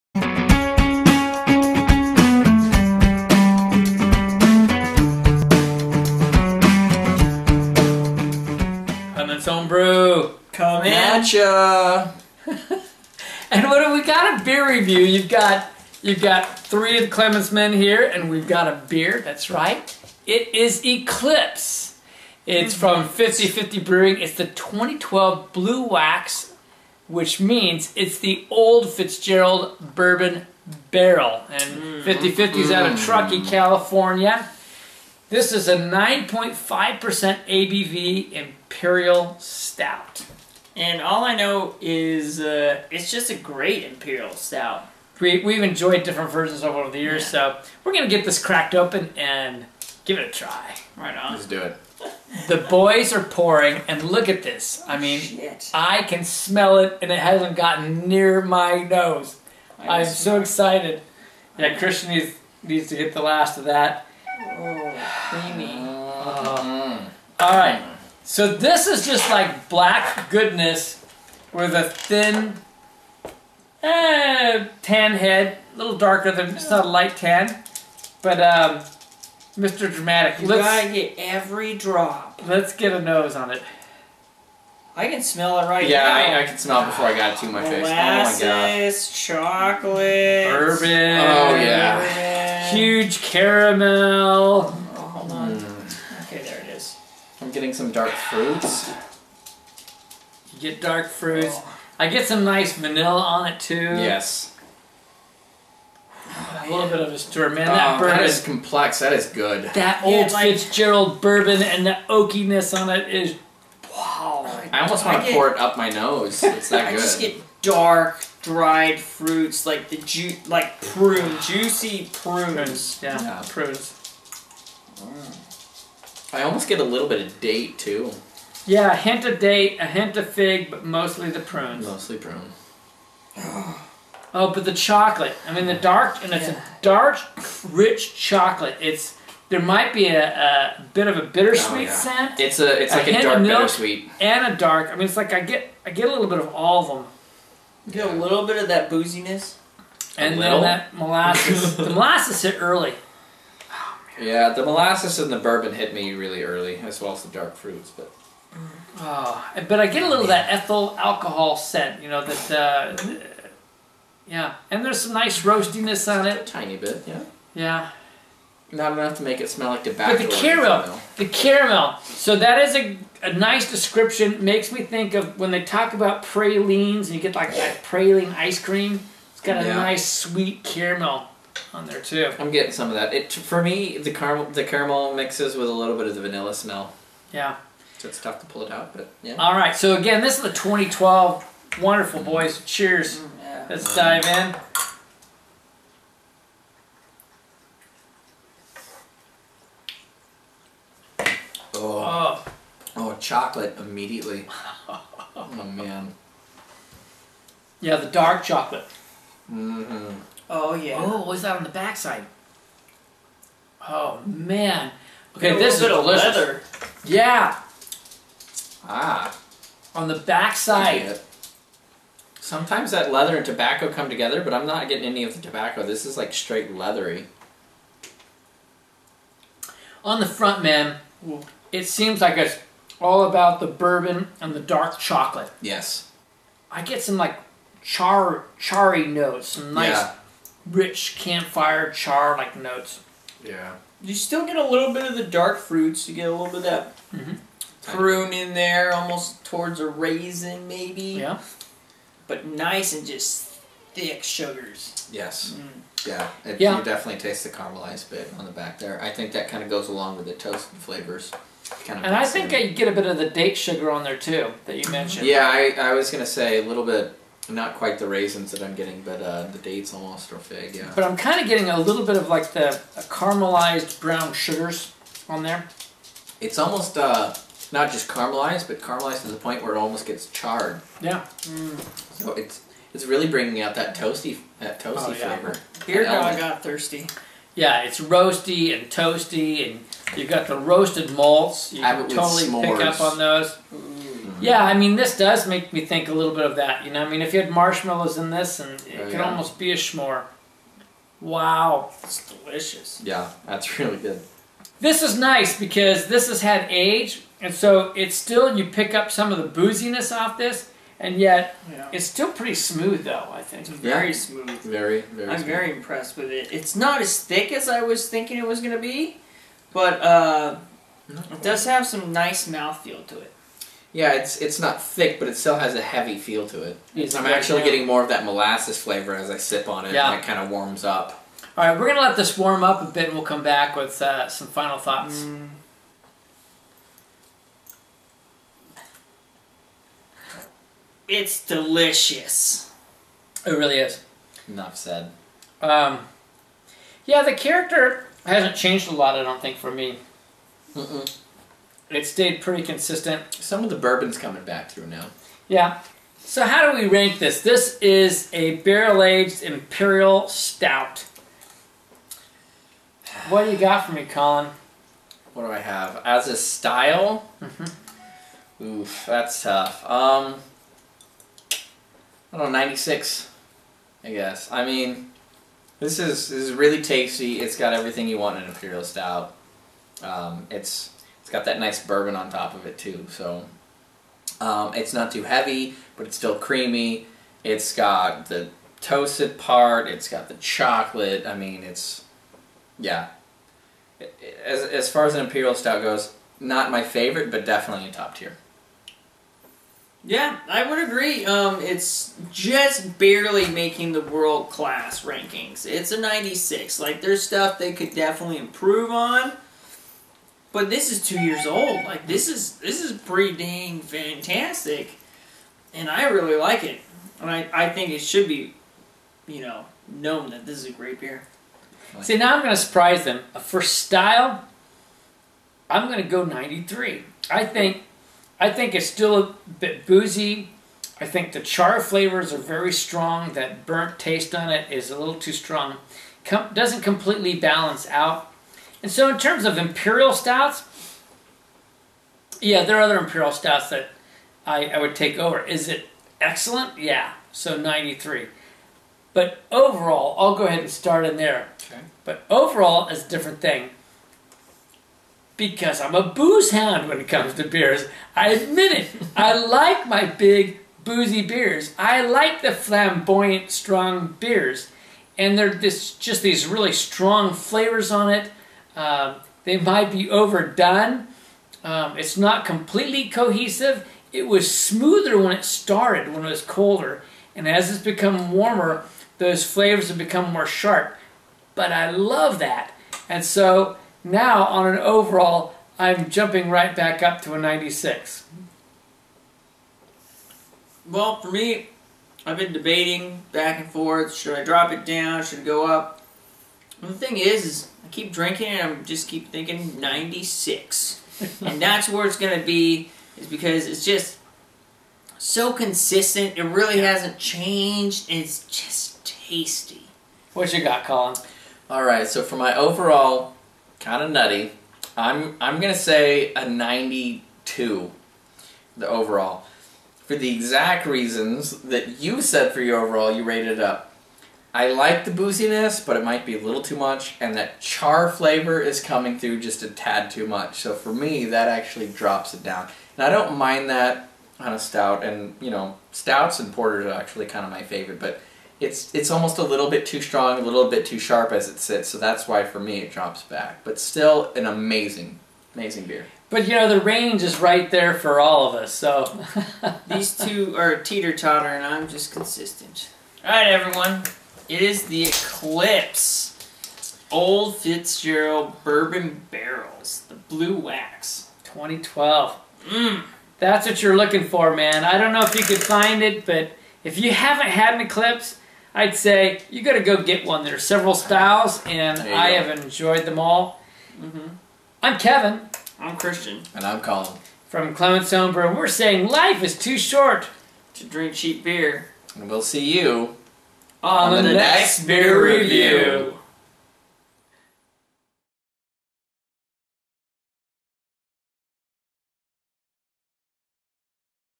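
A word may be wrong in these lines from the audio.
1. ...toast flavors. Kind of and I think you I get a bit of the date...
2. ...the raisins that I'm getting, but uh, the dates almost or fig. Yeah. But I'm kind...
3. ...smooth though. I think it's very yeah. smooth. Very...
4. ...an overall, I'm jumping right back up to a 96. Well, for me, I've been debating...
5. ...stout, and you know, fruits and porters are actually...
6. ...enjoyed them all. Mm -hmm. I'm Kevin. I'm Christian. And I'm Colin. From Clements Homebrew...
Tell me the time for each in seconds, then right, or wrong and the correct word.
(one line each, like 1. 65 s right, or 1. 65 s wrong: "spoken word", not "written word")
1. 260 s right
2. 267 s right
3. 312 s right
4. 484 s right
5. 534 s wrong: "stouts", not "fruits"
6. 572 s right.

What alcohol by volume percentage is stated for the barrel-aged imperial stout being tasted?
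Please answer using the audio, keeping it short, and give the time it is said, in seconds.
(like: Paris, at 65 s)
9.5%, at 35 s.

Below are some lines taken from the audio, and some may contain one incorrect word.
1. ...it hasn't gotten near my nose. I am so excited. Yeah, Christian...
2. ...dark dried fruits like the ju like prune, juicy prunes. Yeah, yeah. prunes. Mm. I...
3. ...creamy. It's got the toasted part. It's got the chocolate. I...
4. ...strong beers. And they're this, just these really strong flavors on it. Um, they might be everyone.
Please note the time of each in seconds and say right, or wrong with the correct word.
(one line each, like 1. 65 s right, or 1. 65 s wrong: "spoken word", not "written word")
1. 57 s right
2. 117 s right
3. 386 s right
4. 463 s wrong: "overdone", not "everyone".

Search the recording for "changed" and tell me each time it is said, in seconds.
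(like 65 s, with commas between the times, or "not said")
348 s, 507 s.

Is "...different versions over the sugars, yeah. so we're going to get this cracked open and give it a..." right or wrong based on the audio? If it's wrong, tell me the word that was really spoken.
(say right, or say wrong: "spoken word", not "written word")
wrong: "years", not "sugars".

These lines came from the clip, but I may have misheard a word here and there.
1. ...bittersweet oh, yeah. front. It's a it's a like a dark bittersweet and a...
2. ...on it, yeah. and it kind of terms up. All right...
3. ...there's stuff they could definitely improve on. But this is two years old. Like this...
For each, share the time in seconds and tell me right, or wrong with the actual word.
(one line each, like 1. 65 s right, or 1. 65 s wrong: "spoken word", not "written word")
1. 141 s wrong: "scent", not "front"
2. 329 s wrong: "warms", not "terms"
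3. 407 s right.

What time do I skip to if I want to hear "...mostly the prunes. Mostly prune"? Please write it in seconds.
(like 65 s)
130 s.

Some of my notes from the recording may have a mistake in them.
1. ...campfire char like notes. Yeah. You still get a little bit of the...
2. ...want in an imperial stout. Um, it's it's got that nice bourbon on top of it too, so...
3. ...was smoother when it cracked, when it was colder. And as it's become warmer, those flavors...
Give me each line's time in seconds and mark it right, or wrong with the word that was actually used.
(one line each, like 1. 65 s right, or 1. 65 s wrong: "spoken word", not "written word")
1. 241 s right
2. 378 s right
3. 474 s wrong: "started", not "cracked".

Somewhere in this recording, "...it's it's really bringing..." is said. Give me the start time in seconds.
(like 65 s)
282 s.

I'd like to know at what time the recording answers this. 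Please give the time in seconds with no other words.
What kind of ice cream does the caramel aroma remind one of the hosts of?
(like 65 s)
177 s.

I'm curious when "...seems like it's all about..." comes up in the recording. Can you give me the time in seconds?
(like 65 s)
231 s.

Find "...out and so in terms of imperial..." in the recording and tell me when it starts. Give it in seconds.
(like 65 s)
437 s.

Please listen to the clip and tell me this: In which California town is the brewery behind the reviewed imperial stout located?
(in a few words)
Truckee.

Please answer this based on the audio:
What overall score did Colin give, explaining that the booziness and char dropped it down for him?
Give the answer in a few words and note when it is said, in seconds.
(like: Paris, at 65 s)
92, at 516 s.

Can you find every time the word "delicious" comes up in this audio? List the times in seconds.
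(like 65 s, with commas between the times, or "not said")
215 s, 302 s, 341 s.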